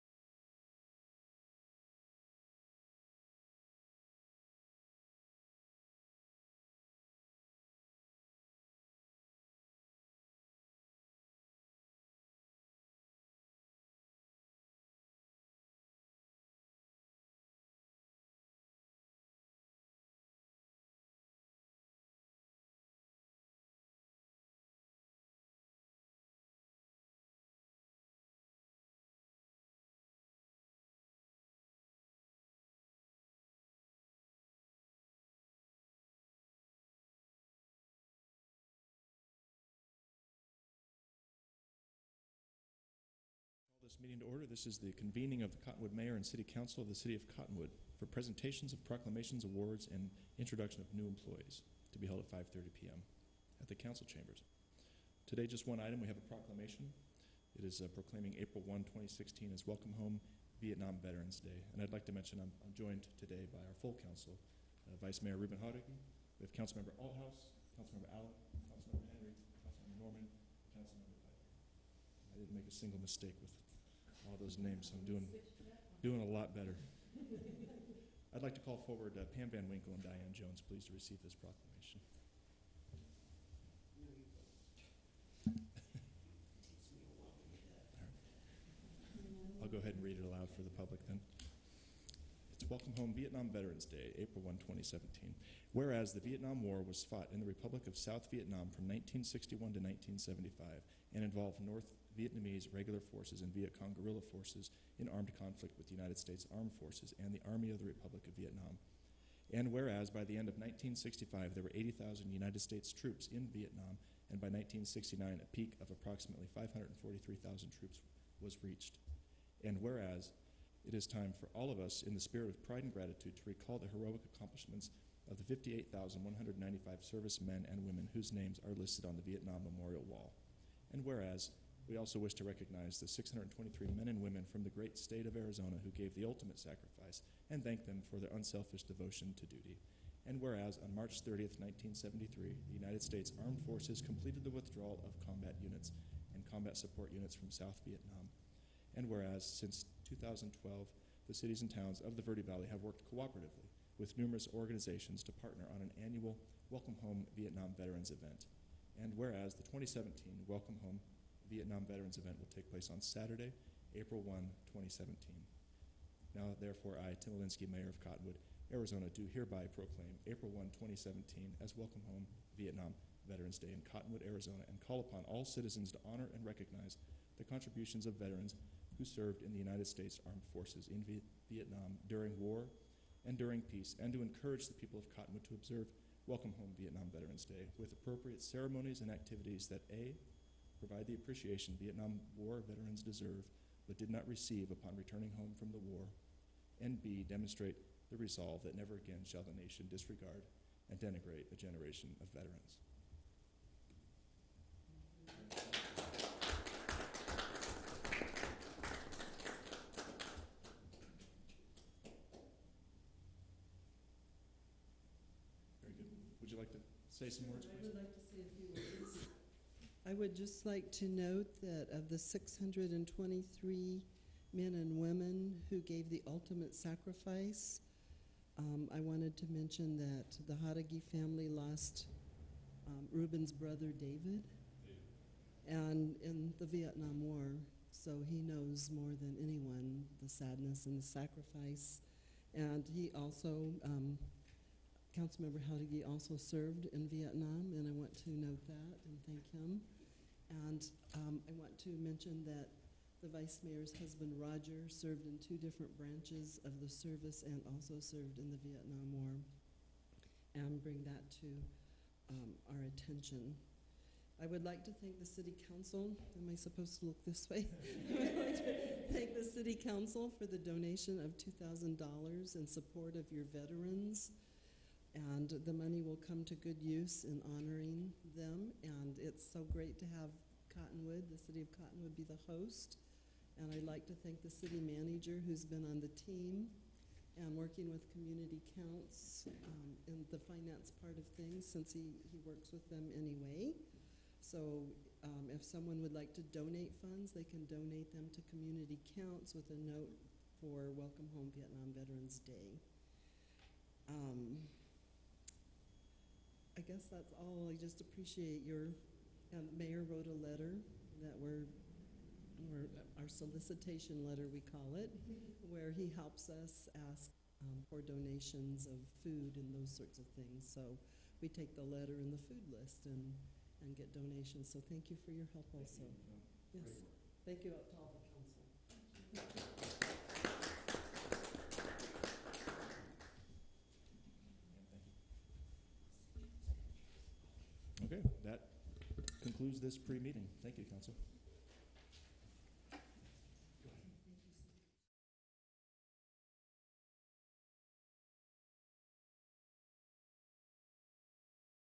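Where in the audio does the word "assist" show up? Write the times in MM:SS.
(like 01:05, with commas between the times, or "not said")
not said.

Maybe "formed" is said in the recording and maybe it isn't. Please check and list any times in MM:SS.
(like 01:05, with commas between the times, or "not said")
not said.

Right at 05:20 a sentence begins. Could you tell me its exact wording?
So we take the letter and the food list and, and get donations.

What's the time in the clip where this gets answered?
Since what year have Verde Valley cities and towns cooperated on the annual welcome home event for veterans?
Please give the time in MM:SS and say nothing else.
02:30.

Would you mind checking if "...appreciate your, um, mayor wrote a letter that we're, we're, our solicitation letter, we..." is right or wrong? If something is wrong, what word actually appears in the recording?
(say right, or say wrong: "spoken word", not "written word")
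right.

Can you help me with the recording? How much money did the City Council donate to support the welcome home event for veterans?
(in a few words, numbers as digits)
$2,000.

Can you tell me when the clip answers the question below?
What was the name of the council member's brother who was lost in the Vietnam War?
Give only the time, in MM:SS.
03:53.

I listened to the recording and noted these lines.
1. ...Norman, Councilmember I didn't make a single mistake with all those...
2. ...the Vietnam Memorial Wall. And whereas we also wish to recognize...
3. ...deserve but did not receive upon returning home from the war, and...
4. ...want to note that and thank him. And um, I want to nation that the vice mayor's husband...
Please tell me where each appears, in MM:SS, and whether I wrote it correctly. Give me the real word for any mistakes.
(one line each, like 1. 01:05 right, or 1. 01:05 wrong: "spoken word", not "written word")
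1. 01:09 right
2. 02:09 right
3. 03:13 right
4. 04:07 wrong: "mention", not "nation".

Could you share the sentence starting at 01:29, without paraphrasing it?
I'll go ahead and read it aloud for the public then.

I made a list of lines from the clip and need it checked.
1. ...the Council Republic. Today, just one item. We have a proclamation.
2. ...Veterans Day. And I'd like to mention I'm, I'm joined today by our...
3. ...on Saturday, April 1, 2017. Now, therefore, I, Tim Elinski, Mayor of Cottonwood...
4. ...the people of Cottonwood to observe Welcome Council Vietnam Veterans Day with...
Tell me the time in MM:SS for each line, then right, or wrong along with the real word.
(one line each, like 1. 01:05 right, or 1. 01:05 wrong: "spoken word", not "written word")
1. 00:53 wrong: "Chambers", not "Republic"
2. 01:01 right
3. 02:42 right
4. 03:04 wrong: "Home", not "Council".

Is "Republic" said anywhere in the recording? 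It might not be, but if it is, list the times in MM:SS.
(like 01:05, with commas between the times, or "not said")
01:37, 01:47.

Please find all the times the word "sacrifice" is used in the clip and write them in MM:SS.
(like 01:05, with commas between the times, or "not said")
02:16, 03:46, 04:01.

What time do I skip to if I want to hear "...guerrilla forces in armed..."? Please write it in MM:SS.
01:43.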